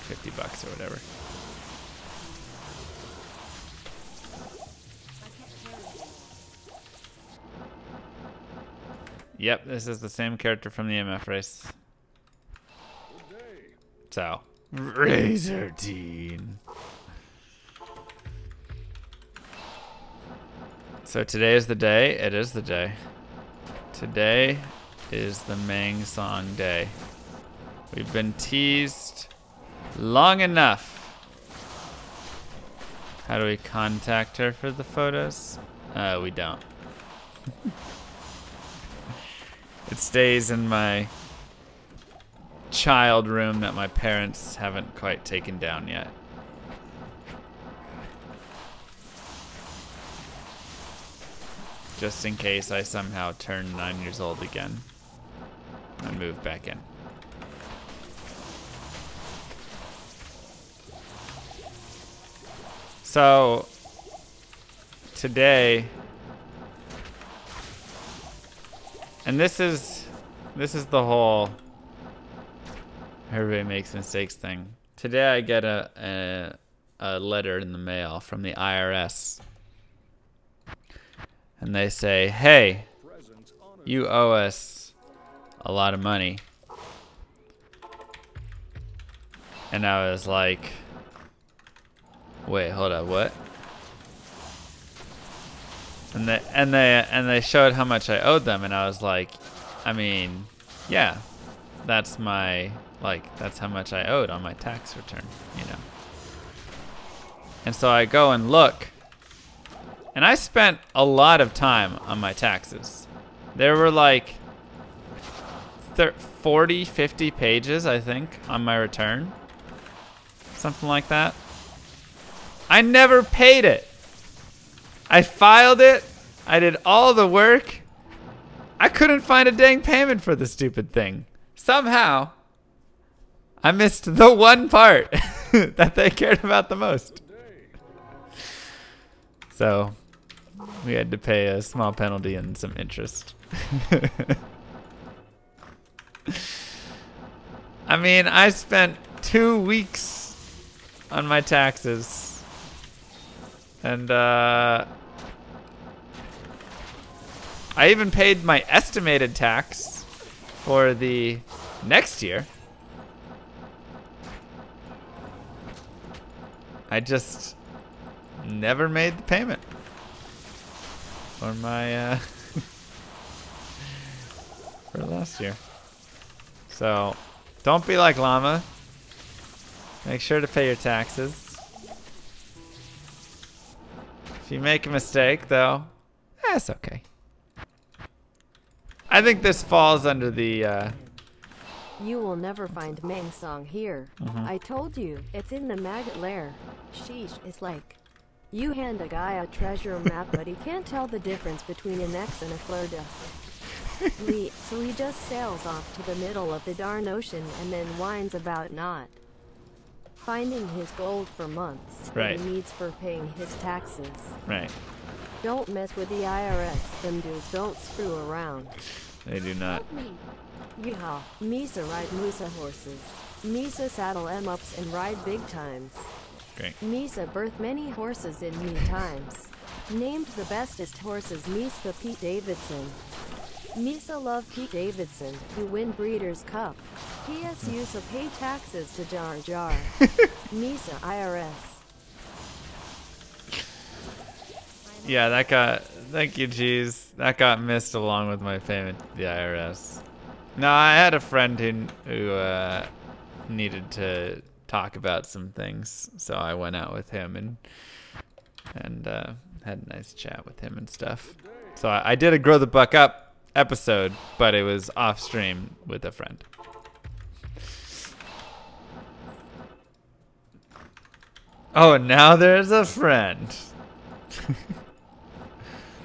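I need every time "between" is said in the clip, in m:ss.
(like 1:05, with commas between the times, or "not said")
3:21.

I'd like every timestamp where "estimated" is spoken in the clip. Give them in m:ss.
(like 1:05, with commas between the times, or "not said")
2:38.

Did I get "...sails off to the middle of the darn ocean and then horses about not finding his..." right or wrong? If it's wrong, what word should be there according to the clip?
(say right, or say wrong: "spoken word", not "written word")
wrong: "whines", not "horses".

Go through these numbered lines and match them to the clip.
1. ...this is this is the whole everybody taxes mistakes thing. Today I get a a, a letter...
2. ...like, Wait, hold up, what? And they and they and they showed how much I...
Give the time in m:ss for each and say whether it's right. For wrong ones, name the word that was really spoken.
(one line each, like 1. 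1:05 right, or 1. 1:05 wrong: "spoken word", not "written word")
1. 1:09 wrong: "makes", not "taxes"
2. 1:30 right.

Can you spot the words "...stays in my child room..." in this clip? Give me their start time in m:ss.
0:39.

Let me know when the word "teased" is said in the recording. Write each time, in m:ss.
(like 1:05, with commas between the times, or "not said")
0:28.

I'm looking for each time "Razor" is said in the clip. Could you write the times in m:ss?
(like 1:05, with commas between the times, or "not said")
0:14.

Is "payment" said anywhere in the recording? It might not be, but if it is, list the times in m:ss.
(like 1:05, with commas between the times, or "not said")
2:09, 2:49, 4:08.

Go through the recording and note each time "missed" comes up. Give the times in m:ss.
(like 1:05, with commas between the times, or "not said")
2:13, 4:07.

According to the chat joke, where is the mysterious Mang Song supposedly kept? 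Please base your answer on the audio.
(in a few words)
The maggot lair.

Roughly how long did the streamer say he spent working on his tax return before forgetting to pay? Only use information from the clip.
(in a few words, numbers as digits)
Two weeks.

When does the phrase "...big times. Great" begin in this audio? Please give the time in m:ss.
3:45.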